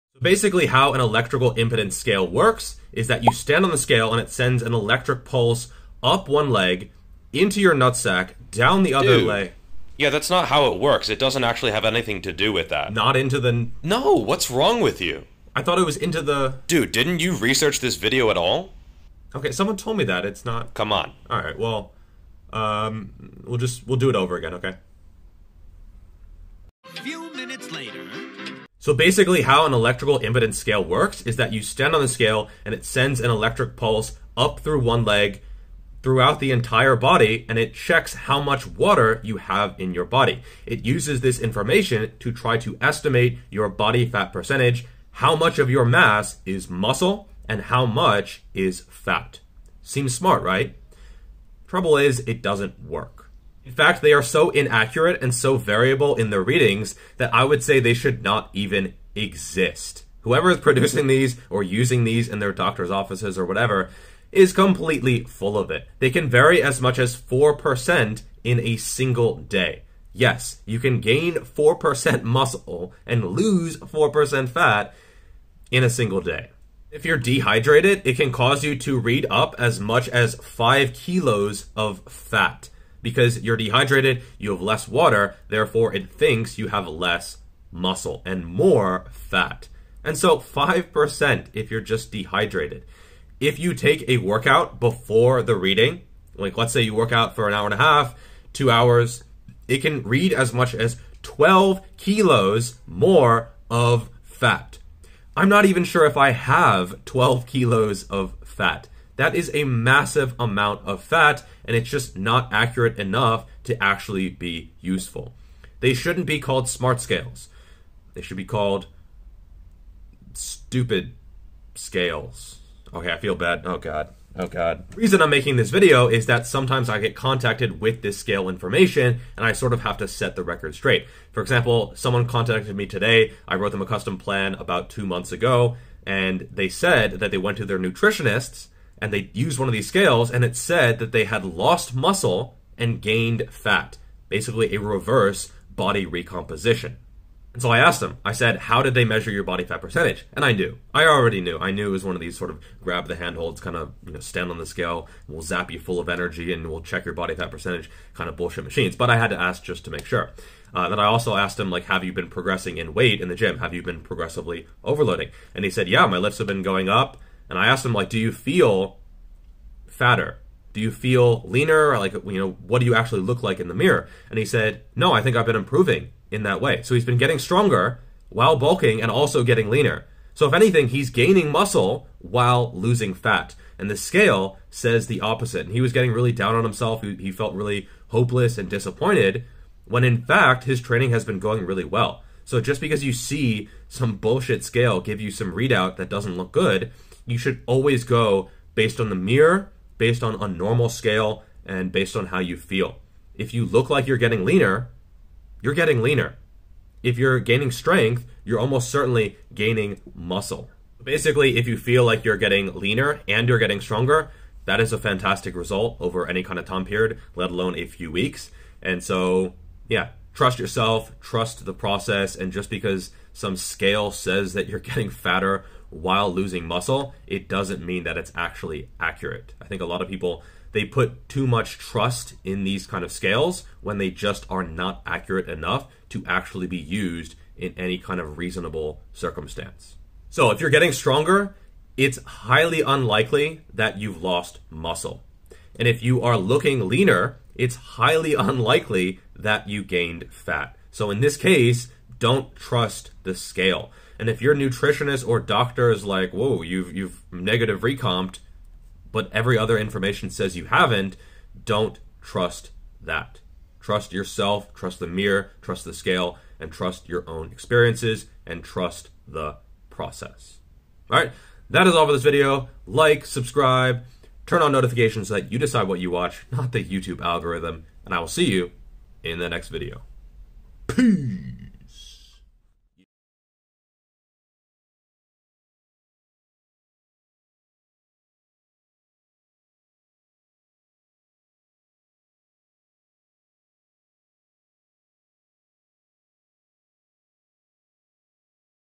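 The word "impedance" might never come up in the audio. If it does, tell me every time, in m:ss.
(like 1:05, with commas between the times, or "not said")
0:01, 0:30.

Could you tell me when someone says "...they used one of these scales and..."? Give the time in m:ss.
2:19.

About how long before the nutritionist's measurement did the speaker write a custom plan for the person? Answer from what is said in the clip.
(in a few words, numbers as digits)
2 months.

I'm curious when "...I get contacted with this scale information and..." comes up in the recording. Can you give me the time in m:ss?
2:06.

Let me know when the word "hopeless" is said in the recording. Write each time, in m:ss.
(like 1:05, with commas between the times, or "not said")
3:08.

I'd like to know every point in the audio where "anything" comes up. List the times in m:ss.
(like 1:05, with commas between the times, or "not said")
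0:11, 3:00.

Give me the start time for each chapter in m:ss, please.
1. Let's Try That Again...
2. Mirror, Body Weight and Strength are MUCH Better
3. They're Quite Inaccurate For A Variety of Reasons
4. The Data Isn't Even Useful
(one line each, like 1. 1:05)
1. 0:28
2. 3:31
3. 0:53
4. 2:05.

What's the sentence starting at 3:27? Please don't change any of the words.
If you're gaining strength, you're almost certainly gaining muscle.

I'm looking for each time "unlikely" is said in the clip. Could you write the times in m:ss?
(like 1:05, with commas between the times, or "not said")
4:02, 4:08.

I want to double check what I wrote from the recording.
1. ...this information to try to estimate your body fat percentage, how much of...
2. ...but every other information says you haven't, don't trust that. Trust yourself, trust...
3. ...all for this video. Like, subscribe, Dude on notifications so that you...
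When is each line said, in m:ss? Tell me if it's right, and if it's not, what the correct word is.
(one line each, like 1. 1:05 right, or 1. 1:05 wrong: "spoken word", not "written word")
1. 0:41 right
2. 4:19 right
3. 4:31 wrong: "Turn", not "Dude".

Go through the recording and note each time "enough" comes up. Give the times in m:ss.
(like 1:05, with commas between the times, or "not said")
1:52, 3:55.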